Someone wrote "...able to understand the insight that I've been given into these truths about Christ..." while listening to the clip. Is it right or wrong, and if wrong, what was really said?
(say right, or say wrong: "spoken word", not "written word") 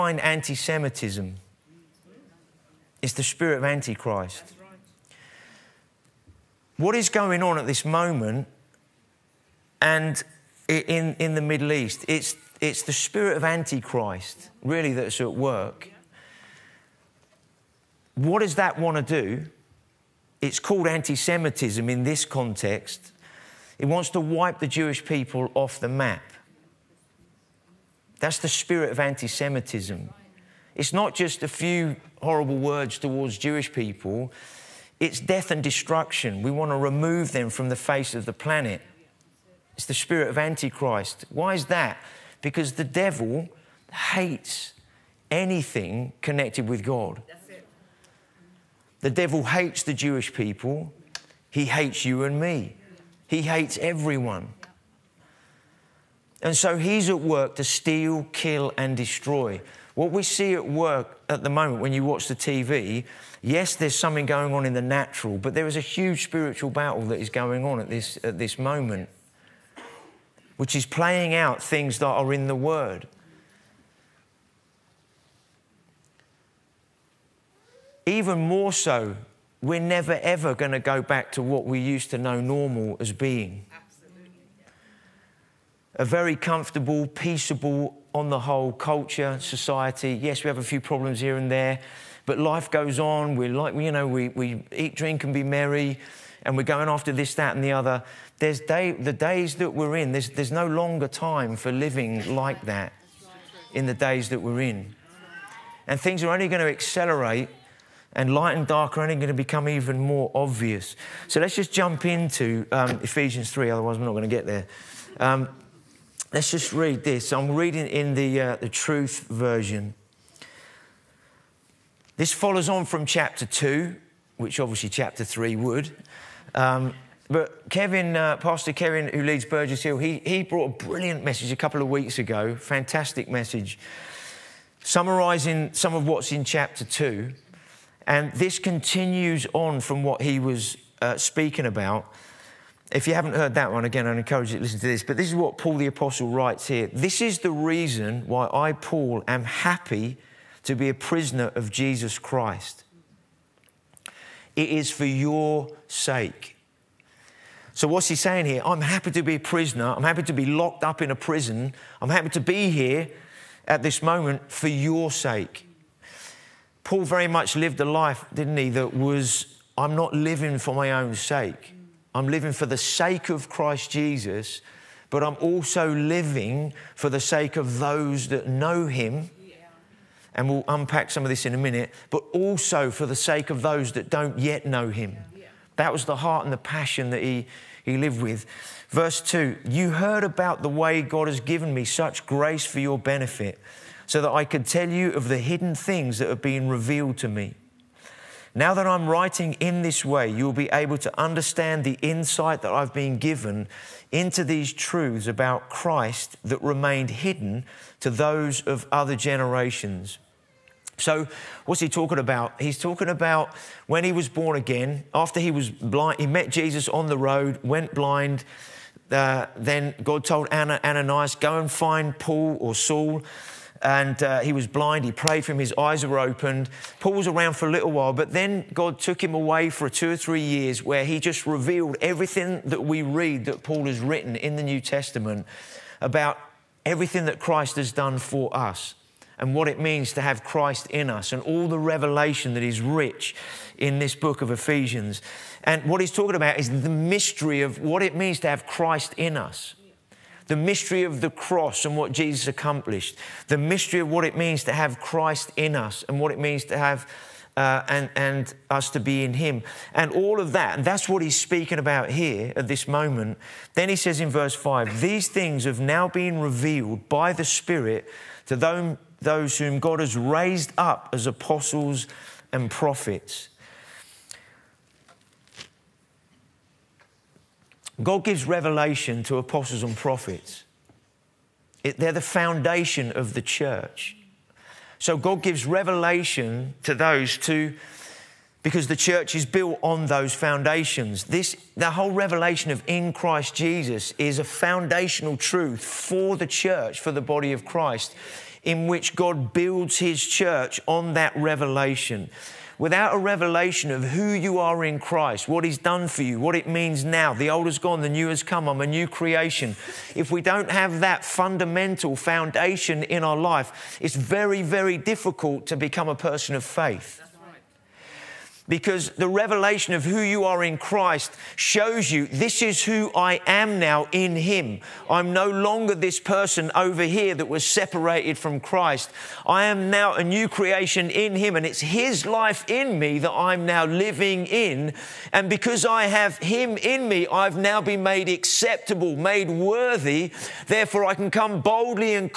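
right.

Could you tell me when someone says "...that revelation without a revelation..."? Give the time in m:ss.
5:01.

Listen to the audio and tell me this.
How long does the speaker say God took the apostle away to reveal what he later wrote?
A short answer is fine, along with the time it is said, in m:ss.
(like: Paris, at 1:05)
2 or 3 years, at 3:49.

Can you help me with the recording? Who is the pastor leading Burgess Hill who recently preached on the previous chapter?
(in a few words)
Pastor Kevin.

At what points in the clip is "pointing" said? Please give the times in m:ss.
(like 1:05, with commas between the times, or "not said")
not said.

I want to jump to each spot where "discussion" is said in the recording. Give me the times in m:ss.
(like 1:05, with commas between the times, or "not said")
not said.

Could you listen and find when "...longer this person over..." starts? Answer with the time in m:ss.
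5:25.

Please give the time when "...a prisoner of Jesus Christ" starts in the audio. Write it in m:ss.
2:30.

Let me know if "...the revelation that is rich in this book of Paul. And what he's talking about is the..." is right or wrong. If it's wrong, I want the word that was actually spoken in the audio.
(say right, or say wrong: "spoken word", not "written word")
wrong: "Ephesians", not "Paul".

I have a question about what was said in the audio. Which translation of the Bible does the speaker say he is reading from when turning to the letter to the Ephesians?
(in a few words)
The Truth Version.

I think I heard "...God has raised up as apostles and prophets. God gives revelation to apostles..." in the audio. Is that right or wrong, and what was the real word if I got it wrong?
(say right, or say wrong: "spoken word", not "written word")
right.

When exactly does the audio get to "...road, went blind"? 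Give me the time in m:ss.
3:37.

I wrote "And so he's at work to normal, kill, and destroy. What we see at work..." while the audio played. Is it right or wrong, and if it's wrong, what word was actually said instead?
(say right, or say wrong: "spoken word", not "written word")
wrong: "steal", not "normal".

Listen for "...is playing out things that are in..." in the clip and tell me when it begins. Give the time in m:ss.
1:10.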